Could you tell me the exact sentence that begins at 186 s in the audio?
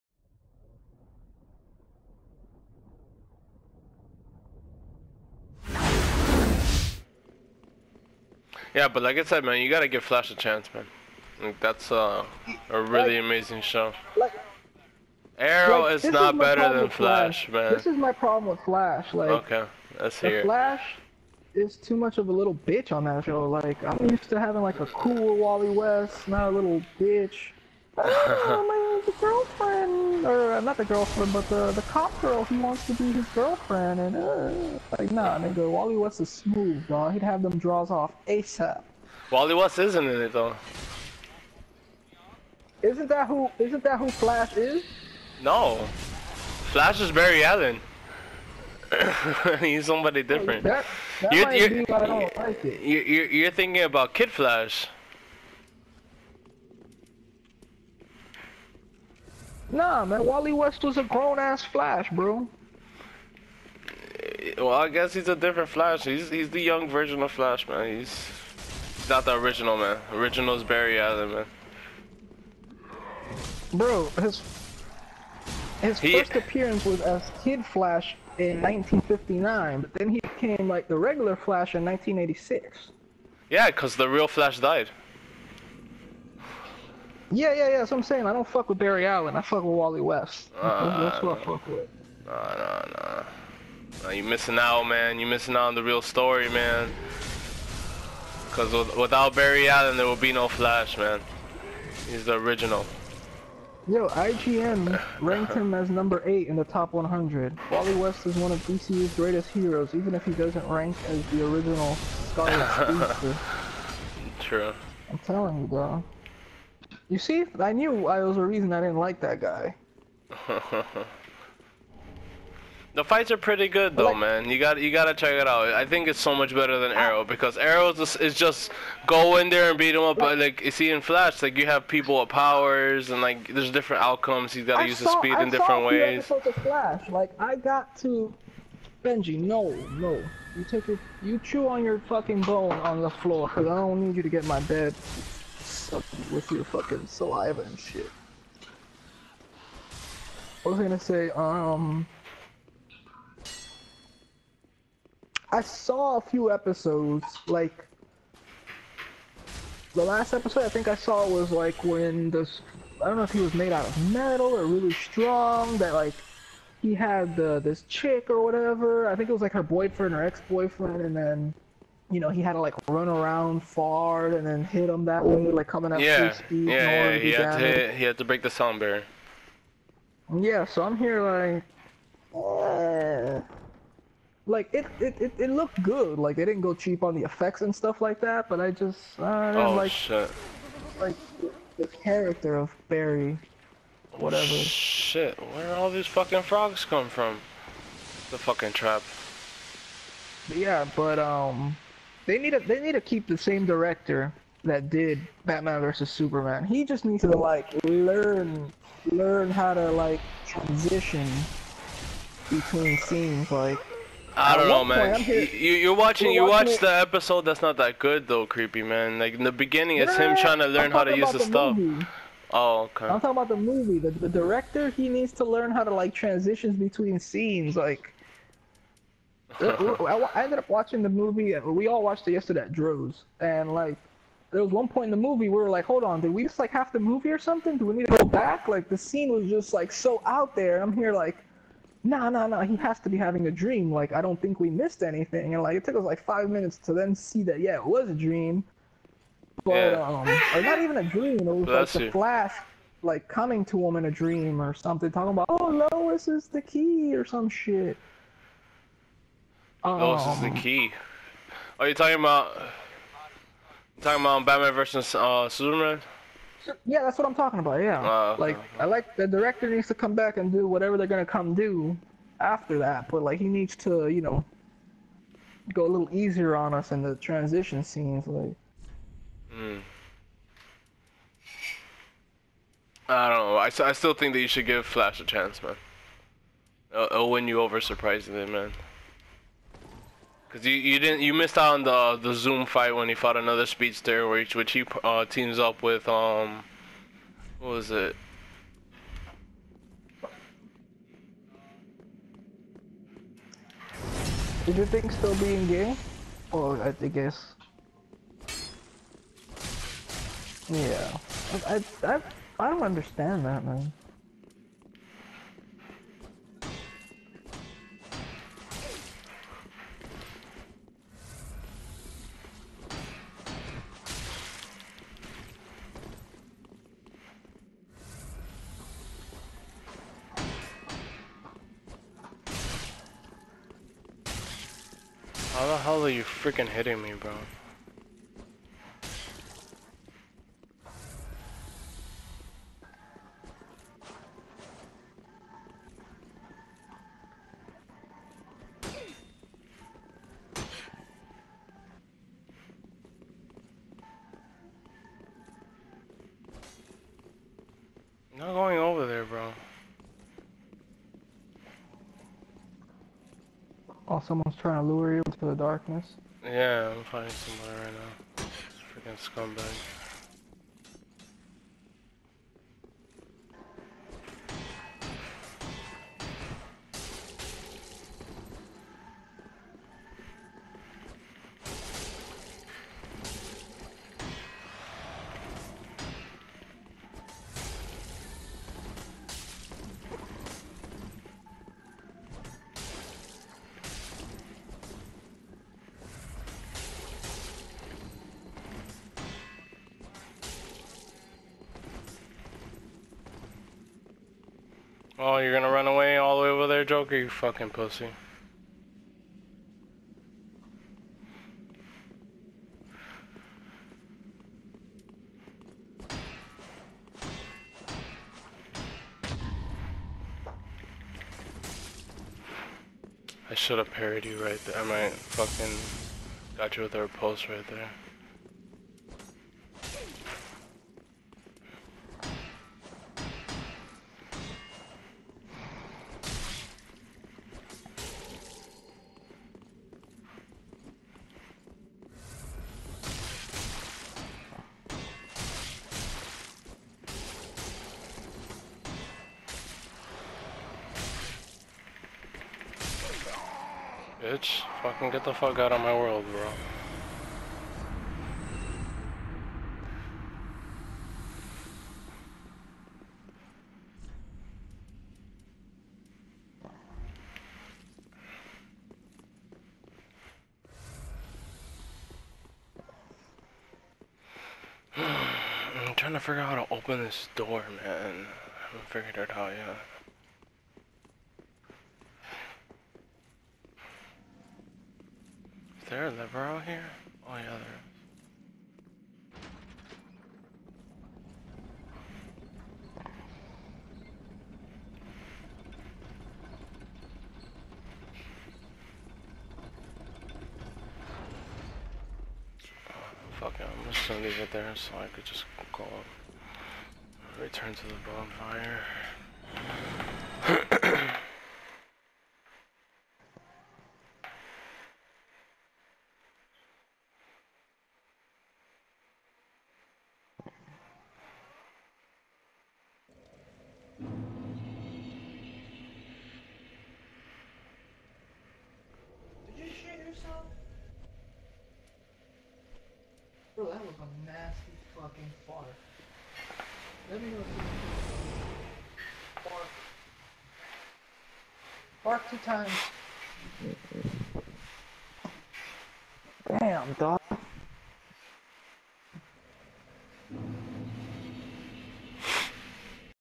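Like they didn't go cheap on the effects and stuff like that, but I just, uh, I oh, like, shit.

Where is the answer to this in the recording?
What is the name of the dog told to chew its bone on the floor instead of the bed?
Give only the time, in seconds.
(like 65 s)
139 s.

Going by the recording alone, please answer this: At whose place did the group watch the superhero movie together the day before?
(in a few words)
Drew's.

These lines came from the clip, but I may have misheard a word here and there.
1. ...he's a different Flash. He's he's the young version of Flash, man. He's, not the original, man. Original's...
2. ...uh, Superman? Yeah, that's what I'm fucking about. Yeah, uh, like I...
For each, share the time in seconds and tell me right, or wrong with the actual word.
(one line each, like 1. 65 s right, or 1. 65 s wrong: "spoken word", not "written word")
1. 65 s right
2. 265 s wrong: "talking", not "fucking".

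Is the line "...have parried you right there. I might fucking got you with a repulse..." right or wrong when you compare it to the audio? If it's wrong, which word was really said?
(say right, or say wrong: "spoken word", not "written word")
right.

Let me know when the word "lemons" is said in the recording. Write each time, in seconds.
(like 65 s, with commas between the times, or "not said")
not said.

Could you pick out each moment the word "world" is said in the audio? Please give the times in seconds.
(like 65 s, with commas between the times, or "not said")
455 s.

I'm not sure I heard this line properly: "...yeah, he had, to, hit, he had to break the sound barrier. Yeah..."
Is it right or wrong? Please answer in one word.
right.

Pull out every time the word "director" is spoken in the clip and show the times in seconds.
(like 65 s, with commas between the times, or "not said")
203 s, 224 s, 269 s.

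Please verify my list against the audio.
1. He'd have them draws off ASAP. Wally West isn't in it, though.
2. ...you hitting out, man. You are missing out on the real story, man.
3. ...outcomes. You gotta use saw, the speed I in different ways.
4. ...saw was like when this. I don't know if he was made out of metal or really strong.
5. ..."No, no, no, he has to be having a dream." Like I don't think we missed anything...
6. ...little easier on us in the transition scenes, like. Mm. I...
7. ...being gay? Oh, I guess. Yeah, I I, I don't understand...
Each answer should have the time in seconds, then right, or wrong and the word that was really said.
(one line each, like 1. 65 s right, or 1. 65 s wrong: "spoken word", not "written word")
1. 37 s right
2. 94 s wrong: "missing", not "hitting"
3. 134 s right
4. 160 s right
5. 242 s right
6. 275 s right
7. 305 s right.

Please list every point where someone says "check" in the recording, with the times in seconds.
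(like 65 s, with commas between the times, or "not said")
125 s.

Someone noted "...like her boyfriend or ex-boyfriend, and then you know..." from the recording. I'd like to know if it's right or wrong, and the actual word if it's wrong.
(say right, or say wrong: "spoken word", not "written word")
right.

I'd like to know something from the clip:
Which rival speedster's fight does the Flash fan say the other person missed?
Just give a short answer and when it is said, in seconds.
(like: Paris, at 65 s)
Zoom, at 292 s.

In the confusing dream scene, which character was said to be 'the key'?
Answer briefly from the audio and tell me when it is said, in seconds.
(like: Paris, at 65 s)
Lois, at 255 s.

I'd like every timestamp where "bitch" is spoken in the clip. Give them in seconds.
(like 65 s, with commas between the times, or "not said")
22 s, 26 s, 454 s.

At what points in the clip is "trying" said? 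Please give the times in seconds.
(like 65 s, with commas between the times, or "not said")
220 s, 364 s, 475 s.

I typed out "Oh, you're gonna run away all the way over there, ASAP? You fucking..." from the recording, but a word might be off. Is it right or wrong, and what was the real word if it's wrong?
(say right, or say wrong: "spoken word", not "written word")
wrong: "Joker", not "ASAP".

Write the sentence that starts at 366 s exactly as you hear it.
Yeah, I'm fighting somebody right now.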